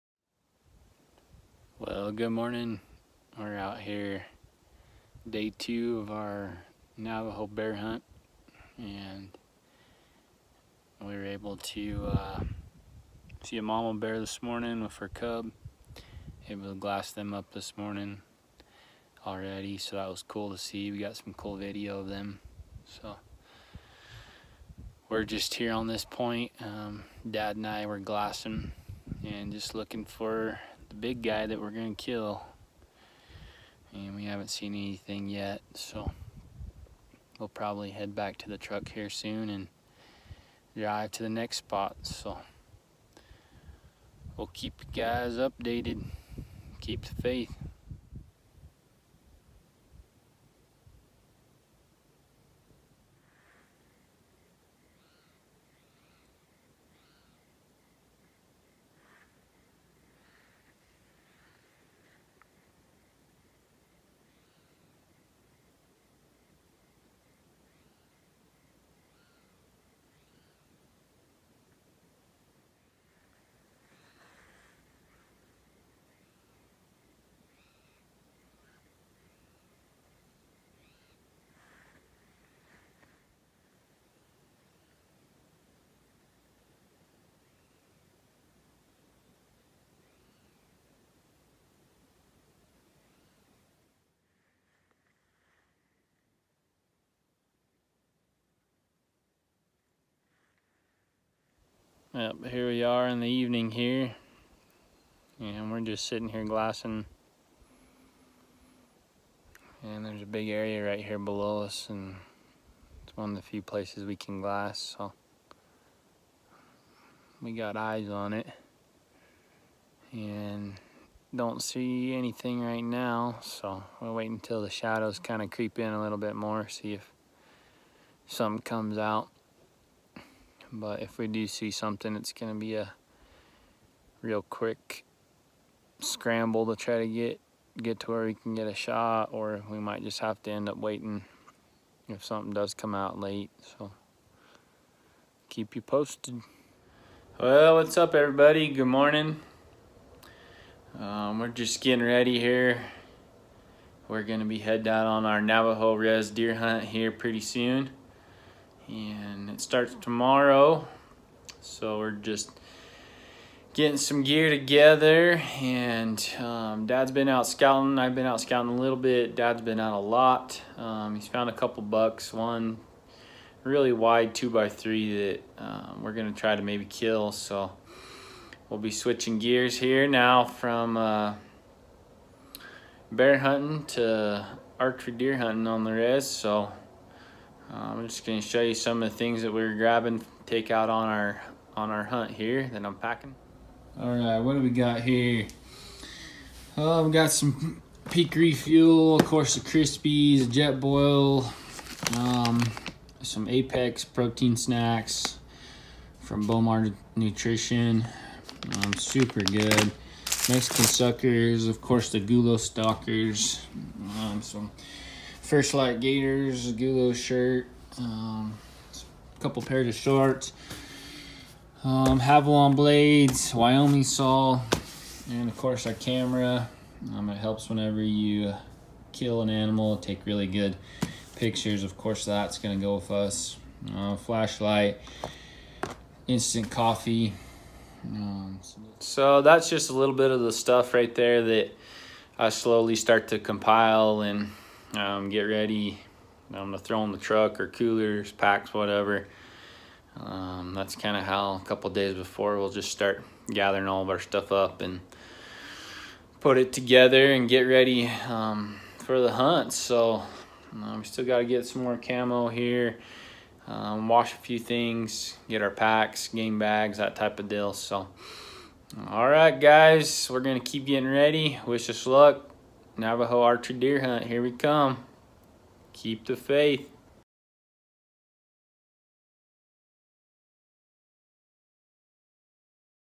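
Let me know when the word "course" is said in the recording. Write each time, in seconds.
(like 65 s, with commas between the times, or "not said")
199 s, 211 s, 225 s, 231 s.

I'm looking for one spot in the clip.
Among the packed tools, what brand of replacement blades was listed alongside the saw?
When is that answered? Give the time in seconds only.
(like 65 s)
222 s.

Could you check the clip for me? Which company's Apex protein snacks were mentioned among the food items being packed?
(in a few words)
Bowmar Nutrition.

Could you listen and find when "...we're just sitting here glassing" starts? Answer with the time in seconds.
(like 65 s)
105 s.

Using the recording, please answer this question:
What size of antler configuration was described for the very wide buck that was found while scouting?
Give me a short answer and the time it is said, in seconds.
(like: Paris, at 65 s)
2 by 3, at 174 s.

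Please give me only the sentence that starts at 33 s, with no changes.
And we haven't seen anything yet, so we'll probably head back to the truck here soon and drive to the next spot.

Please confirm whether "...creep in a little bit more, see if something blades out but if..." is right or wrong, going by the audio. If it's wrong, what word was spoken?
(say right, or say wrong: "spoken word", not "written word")
wrong: "comes", not "blades".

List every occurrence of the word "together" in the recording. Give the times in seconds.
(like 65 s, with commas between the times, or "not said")
164 s, 256 s.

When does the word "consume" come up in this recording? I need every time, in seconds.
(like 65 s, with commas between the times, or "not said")
not said.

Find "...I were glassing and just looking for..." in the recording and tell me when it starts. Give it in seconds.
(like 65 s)
27 s.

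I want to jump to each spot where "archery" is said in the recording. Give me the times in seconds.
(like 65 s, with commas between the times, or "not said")
184 s, 273 s.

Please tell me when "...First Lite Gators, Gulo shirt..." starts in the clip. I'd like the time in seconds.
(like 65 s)
215 s.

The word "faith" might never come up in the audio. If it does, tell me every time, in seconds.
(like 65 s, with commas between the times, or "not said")
47 s, 276 s.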